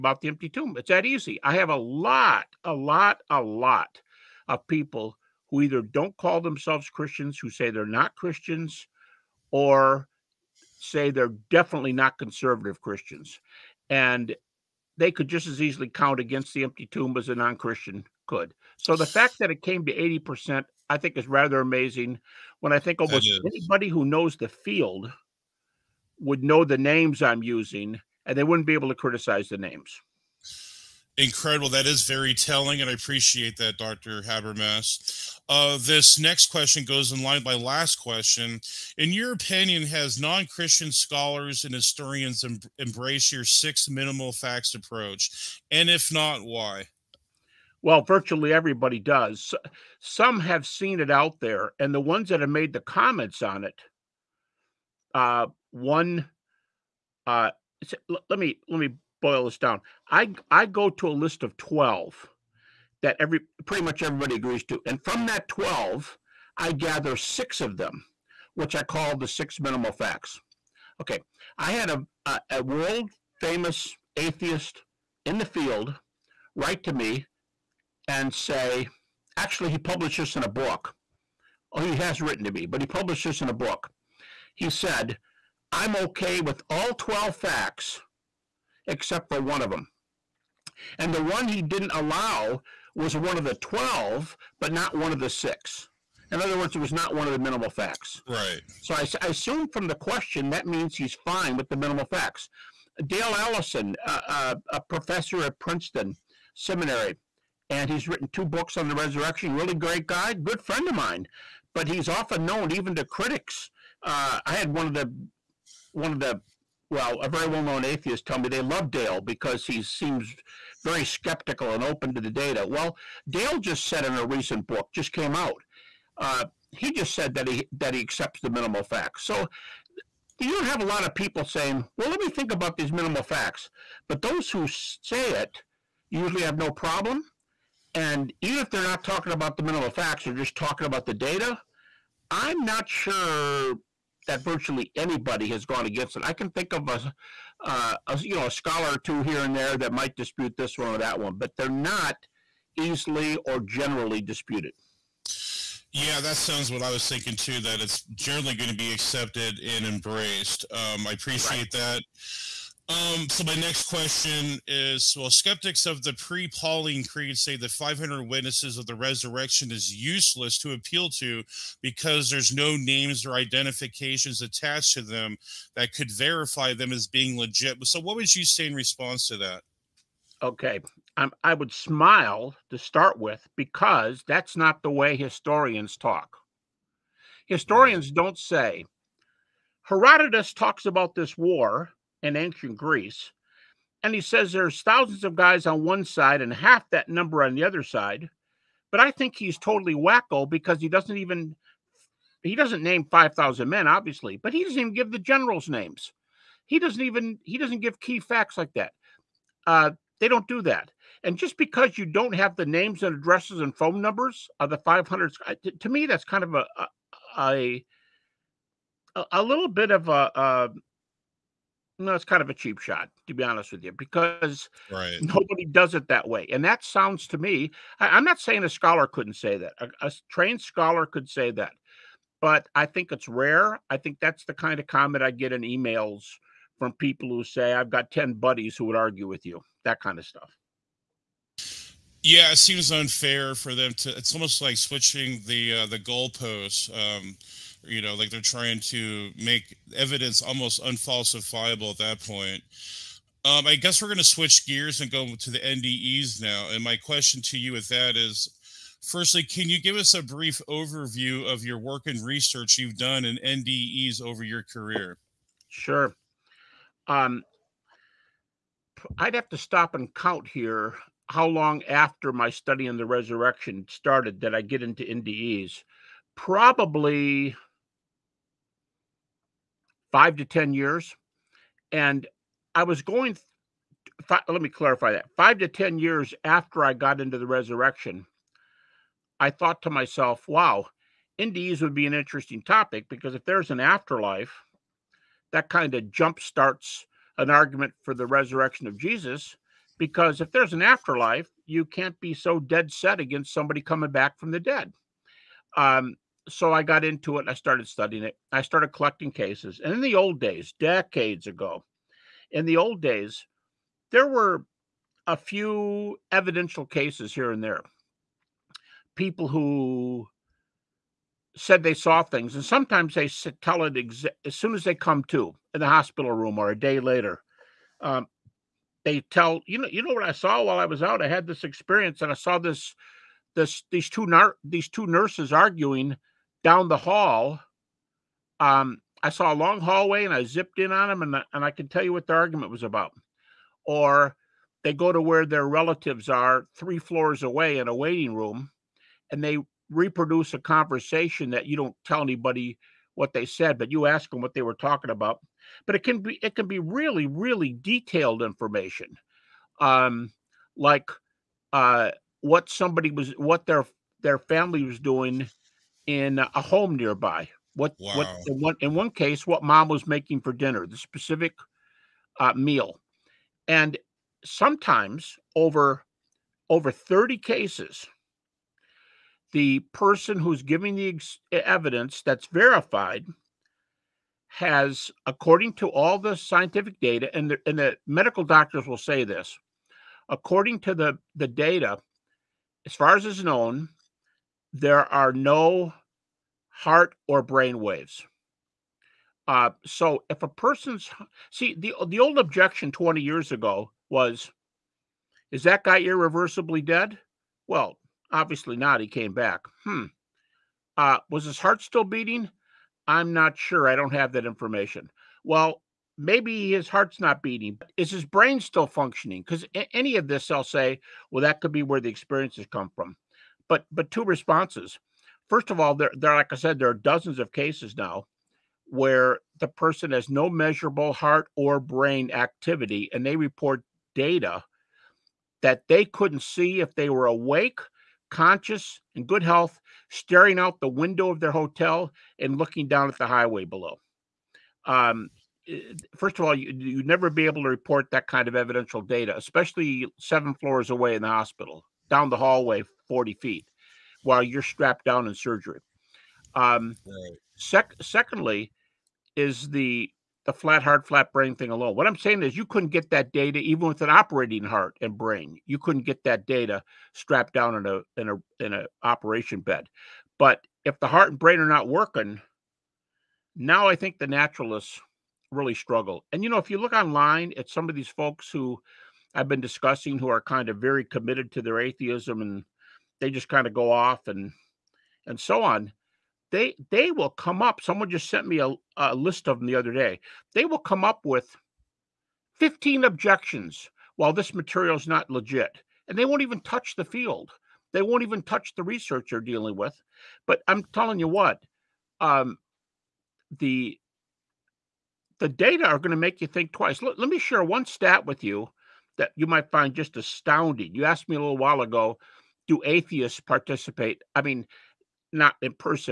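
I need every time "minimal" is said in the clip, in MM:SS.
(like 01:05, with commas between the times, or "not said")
00:43, 01:09, 01:37, 01:41, 02:08, 02:12, 02:19.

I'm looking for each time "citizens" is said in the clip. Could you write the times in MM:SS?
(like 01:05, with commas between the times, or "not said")
not said.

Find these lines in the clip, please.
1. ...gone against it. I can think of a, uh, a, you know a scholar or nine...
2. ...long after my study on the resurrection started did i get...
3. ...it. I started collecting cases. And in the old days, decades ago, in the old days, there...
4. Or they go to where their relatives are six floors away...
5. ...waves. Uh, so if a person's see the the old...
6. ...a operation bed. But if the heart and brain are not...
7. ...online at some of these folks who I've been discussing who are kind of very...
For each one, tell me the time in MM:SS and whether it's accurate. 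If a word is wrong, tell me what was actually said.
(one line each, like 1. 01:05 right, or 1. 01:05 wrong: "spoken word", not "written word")
1. 02:25 wrong: "two", not "nine"
2. 04:31 right
3. 05:08 right
4. 05:43 wrong: "three", not "six"
5. 06:37 right
6. 07:48 right
7. 07:56 right.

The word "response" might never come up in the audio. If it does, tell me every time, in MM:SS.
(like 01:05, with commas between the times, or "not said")
02:58, 07:04.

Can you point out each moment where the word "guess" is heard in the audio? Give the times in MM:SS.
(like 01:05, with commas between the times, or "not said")
04:13.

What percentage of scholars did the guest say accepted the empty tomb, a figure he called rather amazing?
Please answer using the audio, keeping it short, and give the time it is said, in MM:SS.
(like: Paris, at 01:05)
80%, at 00:19.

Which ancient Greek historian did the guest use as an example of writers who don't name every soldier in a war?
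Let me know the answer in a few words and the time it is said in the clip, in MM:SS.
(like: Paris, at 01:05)
Herodotus, at 03:09.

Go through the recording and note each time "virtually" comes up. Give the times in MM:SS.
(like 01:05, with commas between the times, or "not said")
00:48, 02:24.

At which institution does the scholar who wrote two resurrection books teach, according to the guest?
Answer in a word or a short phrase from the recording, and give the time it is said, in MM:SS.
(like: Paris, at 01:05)
Princeton Seminary, at 01:45.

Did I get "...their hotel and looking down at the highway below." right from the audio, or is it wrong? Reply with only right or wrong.
right.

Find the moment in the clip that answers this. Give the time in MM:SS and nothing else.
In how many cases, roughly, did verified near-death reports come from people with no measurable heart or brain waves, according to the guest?
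06:16.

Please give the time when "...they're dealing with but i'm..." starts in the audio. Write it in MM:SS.
08:19.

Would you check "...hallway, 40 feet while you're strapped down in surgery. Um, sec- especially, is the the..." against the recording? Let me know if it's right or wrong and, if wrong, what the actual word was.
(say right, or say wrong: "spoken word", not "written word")
wrong: "secondly", not "especially".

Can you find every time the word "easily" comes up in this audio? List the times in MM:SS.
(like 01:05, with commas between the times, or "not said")
00:15, 02:32.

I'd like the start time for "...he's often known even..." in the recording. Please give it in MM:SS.
01:51.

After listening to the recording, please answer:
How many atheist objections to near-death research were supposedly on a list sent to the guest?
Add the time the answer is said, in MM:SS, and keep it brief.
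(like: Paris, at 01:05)
15, at 08:12.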